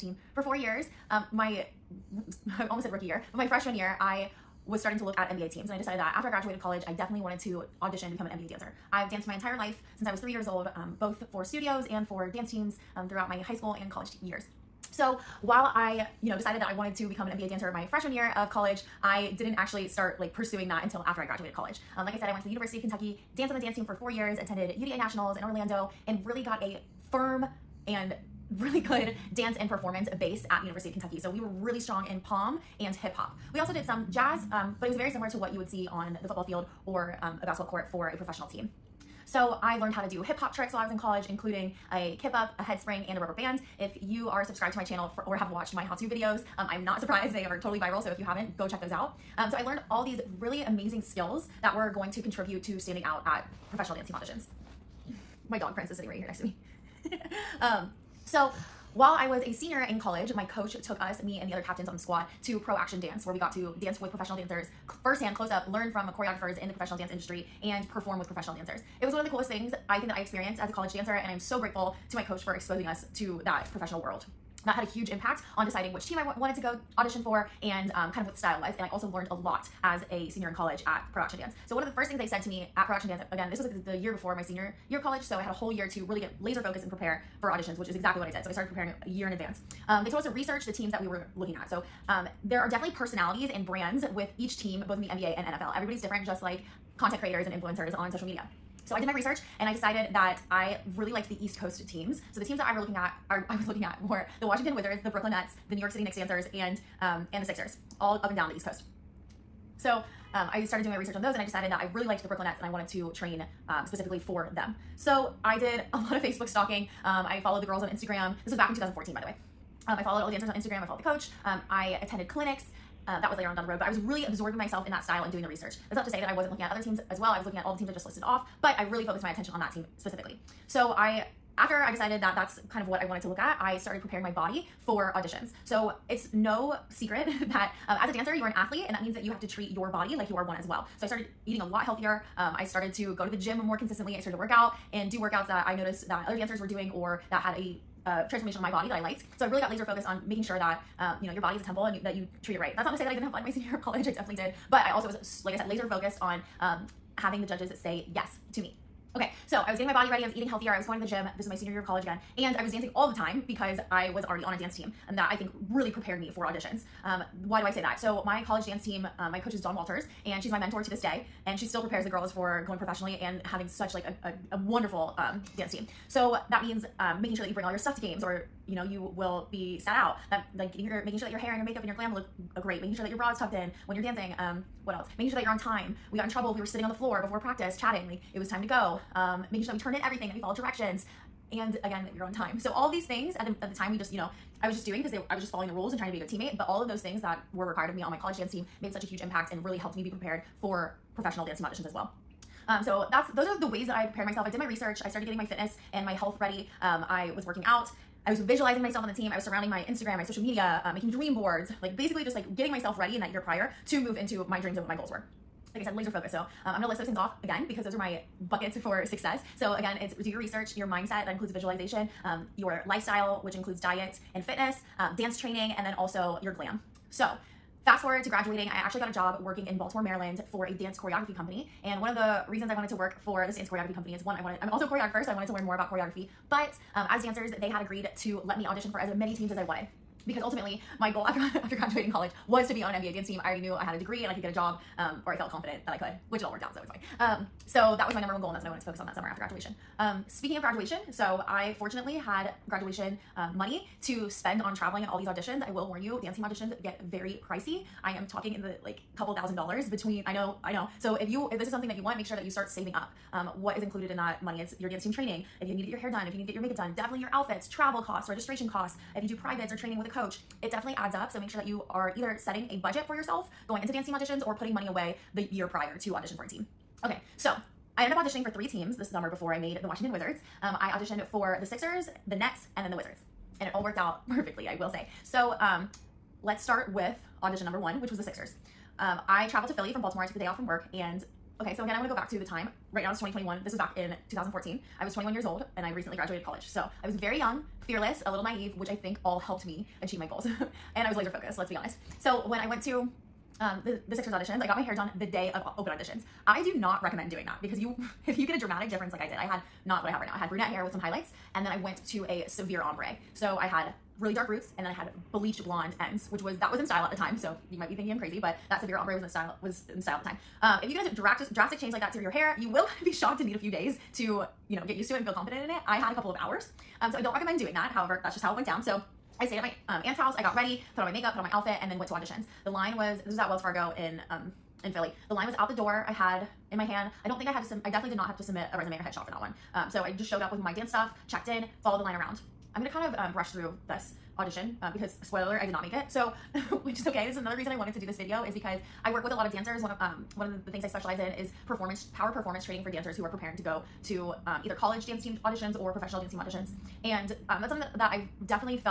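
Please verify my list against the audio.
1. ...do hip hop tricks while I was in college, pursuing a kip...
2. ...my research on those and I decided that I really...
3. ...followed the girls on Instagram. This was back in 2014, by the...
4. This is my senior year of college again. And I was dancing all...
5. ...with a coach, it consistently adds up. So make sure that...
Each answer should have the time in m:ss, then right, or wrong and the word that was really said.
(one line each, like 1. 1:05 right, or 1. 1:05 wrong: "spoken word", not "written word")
1. 0:40 wrong: "including", not "pursuing"
2. 1:50 right
3. 1:57 right
4. 2:41 right
5. 4:29 wrong: "definitely", not "consistently".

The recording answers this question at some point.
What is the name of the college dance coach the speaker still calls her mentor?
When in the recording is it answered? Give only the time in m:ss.
2:49.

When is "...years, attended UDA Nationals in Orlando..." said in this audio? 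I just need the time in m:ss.
0:24.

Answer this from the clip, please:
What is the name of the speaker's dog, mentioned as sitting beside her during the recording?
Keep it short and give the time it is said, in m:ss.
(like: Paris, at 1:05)
Prince, at 0:55.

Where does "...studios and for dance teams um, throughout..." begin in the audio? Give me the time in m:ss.
0:11.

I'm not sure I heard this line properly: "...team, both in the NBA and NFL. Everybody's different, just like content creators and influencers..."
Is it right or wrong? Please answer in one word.
right.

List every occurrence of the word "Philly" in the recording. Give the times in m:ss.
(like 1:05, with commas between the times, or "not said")
4:49, 5:34.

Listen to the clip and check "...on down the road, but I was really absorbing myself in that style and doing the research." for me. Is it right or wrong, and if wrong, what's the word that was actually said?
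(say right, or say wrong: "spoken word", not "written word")
right.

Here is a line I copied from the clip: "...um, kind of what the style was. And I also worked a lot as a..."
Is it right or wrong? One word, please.
wrong.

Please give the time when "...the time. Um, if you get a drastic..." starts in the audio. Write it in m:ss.
5:20.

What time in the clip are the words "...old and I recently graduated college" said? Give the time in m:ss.
4:55.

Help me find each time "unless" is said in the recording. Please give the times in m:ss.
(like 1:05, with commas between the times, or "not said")
not said.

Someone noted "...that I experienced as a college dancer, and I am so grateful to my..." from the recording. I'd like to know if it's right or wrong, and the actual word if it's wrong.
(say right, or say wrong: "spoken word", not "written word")
right.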